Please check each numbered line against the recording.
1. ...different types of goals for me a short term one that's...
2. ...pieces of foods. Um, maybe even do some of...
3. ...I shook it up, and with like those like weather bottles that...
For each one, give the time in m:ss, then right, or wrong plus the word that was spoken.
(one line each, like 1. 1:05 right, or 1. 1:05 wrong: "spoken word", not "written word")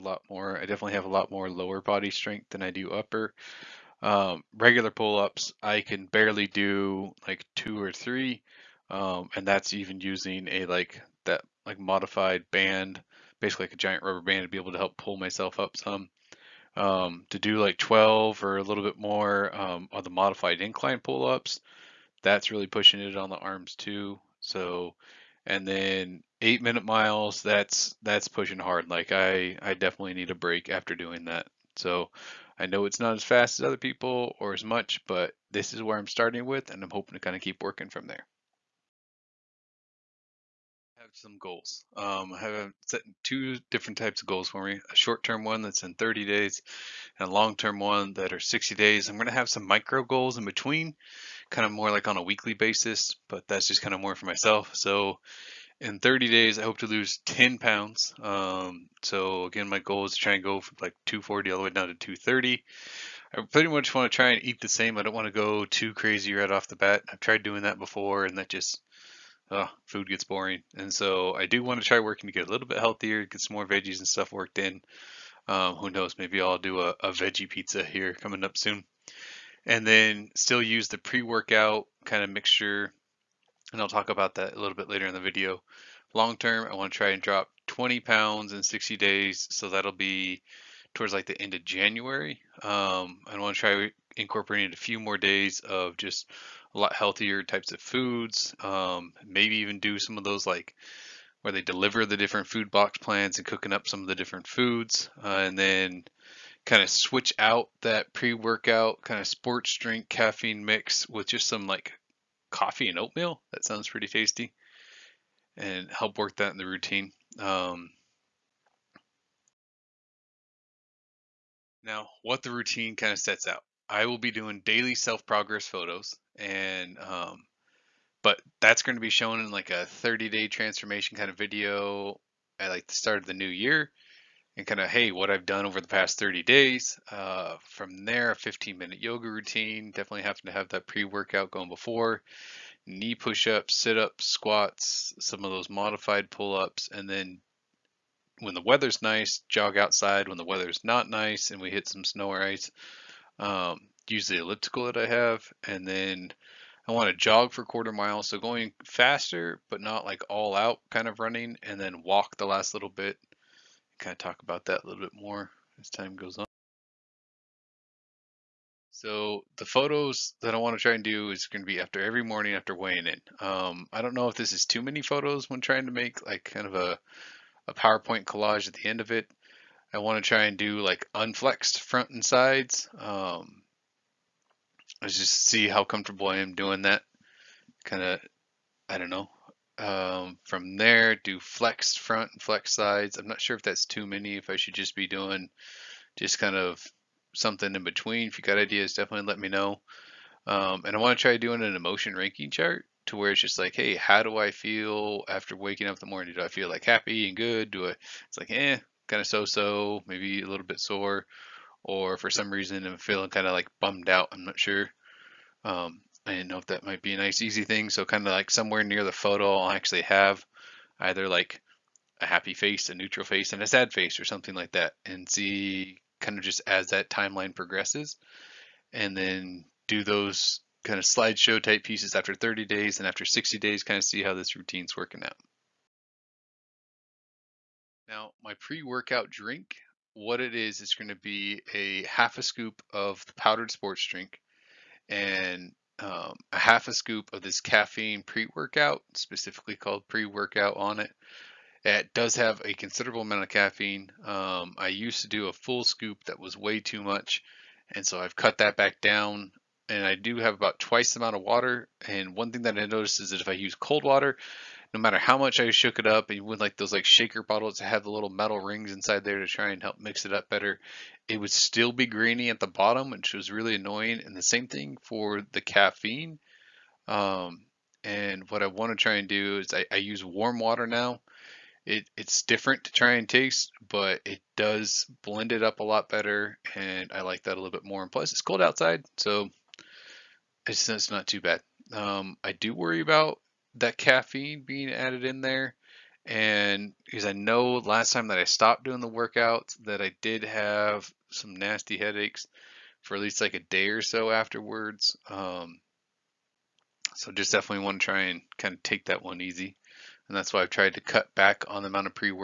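1. 0:43 right
2. 1:37 wrong: "types", not "pieces"
3. 4:25 wrong: "shaker", not "weather".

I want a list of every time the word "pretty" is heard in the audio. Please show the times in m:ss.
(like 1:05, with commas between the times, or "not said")
1:03, 1:53.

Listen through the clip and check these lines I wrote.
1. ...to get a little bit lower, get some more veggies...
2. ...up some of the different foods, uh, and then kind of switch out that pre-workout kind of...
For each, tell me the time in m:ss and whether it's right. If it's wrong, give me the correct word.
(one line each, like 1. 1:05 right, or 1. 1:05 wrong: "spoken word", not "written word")
1. 1:12 wrong: "healthier", not "lower"
2. 1:43 right.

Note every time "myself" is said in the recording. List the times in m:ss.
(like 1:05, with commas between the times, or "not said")
0:15, 0:54.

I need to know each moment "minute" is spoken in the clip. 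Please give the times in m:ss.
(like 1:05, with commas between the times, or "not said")
0:26, 2:18.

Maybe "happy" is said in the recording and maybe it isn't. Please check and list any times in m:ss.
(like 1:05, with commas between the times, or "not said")
3:26, 3:42.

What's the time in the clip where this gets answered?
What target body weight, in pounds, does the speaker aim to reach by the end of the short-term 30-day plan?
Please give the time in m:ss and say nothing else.
1:01.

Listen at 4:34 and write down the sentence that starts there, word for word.
And the same thing for the caffeine.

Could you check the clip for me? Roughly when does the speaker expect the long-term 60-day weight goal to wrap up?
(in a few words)
end of January.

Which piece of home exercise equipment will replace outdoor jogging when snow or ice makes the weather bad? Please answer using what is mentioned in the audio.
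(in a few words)
elliptical.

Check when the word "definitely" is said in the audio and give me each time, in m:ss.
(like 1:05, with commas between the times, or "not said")
0:00, 0:29, 2:19, 3:18, 5:07.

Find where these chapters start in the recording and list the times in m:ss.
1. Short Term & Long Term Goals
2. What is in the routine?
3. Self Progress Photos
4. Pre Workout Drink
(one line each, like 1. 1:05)
1. 0:42
2. 2:03
3. 2:54
4. 3:55.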